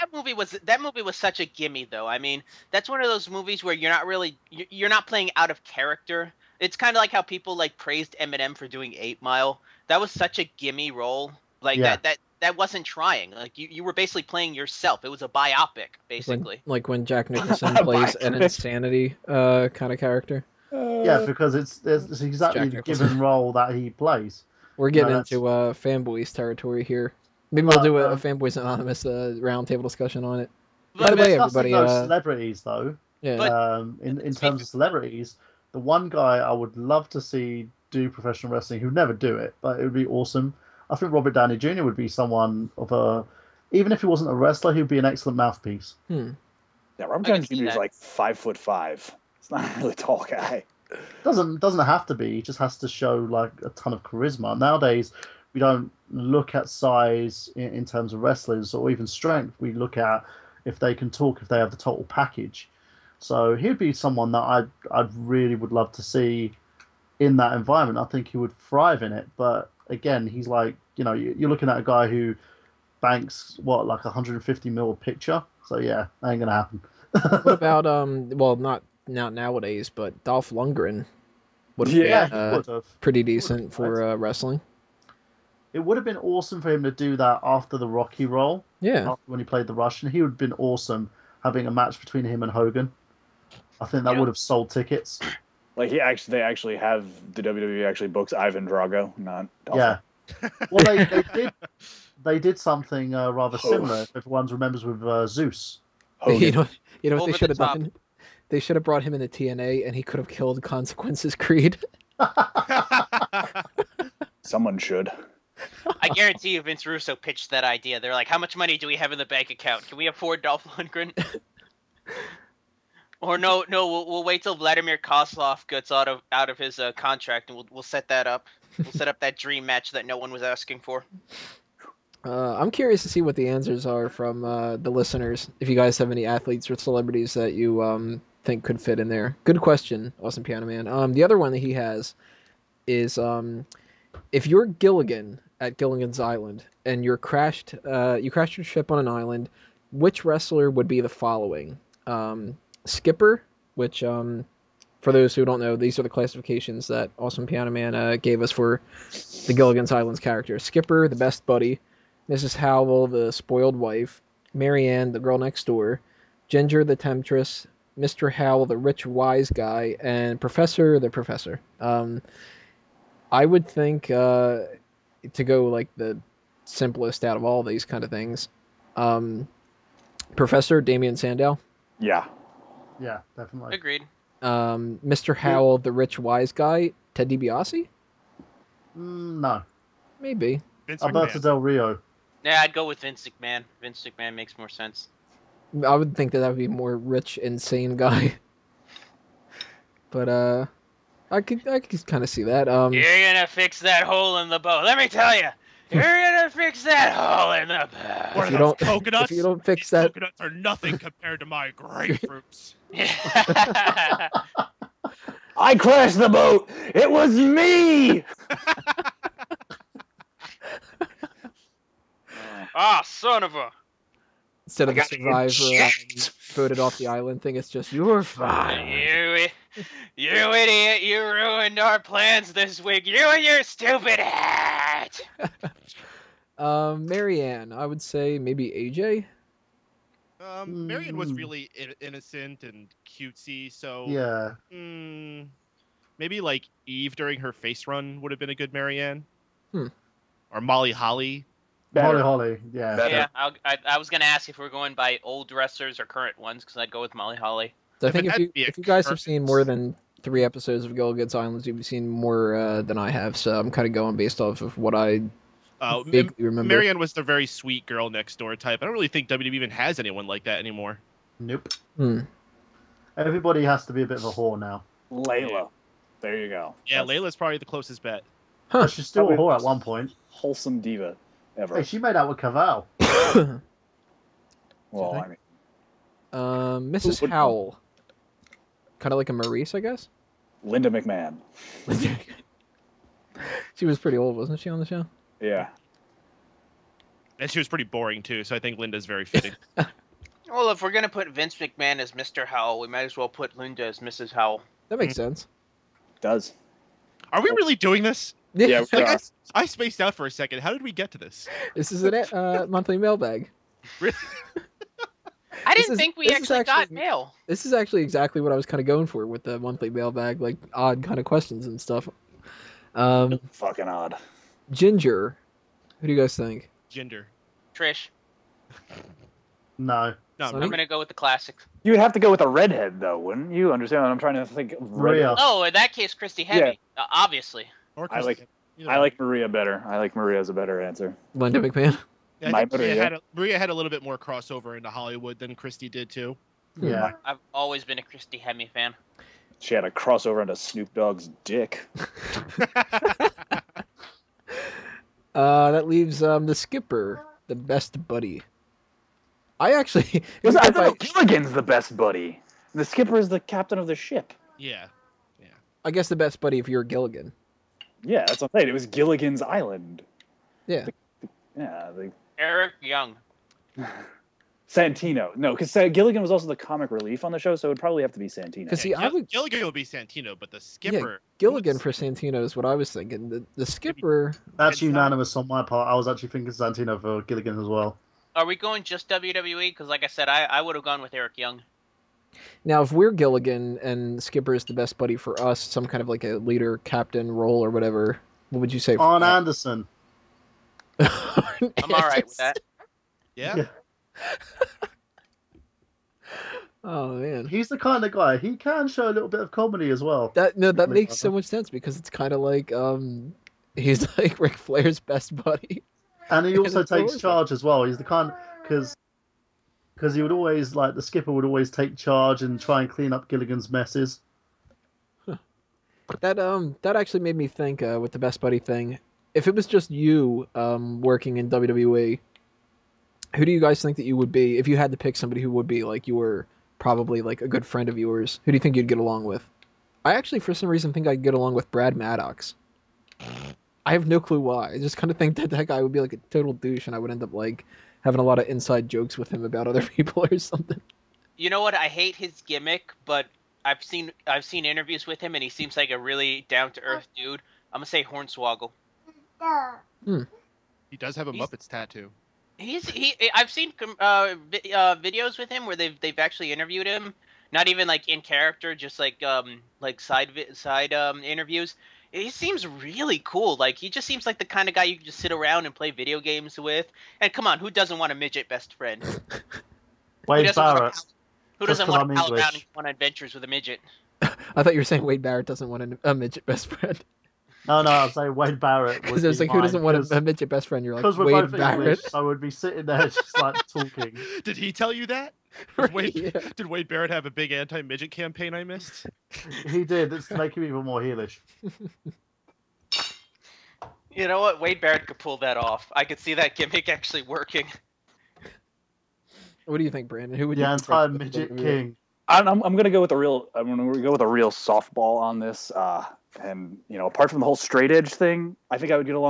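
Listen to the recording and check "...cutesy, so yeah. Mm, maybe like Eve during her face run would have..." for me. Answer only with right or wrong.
right.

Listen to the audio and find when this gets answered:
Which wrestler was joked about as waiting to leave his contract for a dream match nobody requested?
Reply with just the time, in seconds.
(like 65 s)
124 s.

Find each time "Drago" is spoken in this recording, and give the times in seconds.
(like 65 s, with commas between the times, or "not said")
98 s.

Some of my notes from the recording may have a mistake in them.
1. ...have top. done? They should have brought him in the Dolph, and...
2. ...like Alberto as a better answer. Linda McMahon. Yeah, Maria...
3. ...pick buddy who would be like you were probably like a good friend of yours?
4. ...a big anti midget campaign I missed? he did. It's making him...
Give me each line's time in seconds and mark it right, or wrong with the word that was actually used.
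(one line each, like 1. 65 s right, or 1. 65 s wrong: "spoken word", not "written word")
1. 107 s wrong: "TNA", not "Dolph"
2. 339 s wrong: "Maria", not "Alberto"
3. 434 s wrong: "somebody", not "buddy"
4. 497 s right.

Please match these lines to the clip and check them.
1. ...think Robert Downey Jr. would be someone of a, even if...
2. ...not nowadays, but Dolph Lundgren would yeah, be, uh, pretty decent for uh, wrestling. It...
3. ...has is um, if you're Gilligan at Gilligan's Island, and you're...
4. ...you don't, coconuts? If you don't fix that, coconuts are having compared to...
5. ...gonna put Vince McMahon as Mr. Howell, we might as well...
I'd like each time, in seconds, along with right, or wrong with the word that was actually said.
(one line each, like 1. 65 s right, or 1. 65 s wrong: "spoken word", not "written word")
1. 40 s right
2. 79 s right
3. 141 s right
4. 208 s wrong: "nothing", not "having"
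5. 300 s right.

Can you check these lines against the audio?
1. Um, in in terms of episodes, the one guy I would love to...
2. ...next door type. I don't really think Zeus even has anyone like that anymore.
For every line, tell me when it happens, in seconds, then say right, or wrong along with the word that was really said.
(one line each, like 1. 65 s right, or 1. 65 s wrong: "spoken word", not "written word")
1. 33 s wrong: "celebrities", not "episodes"
2. 268 s wrong: "WWE", not "Zeus".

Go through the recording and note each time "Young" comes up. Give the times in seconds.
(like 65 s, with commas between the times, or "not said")
372 s, 391 s.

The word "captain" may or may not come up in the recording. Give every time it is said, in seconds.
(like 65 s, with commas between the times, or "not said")
363 s, 396 s.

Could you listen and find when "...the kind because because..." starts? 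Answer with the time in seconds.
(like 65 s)
417 s.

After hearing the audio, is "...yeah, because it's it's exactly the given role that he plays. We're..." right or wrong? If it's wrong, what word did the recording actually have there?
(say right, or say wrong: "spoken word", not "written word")
right.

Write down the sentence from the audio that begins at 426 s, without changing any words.
That um that actually made me think uh, with the best buddy thing.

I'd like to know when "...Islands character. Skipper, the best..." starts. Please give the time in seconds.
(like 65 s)
159 s.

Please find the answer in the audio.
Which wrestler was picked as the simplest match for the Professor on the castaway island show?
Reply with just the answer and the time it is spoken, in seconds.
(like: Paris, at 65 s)
Damien Sandow, at 180 s.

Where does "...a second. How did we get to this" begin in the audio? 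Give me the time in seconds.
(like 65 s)
310 s.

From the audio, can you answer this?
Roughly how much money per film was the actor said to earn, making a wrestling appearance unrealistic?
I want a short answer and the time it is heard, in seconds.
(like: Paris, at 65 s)
150 million, at 74 s.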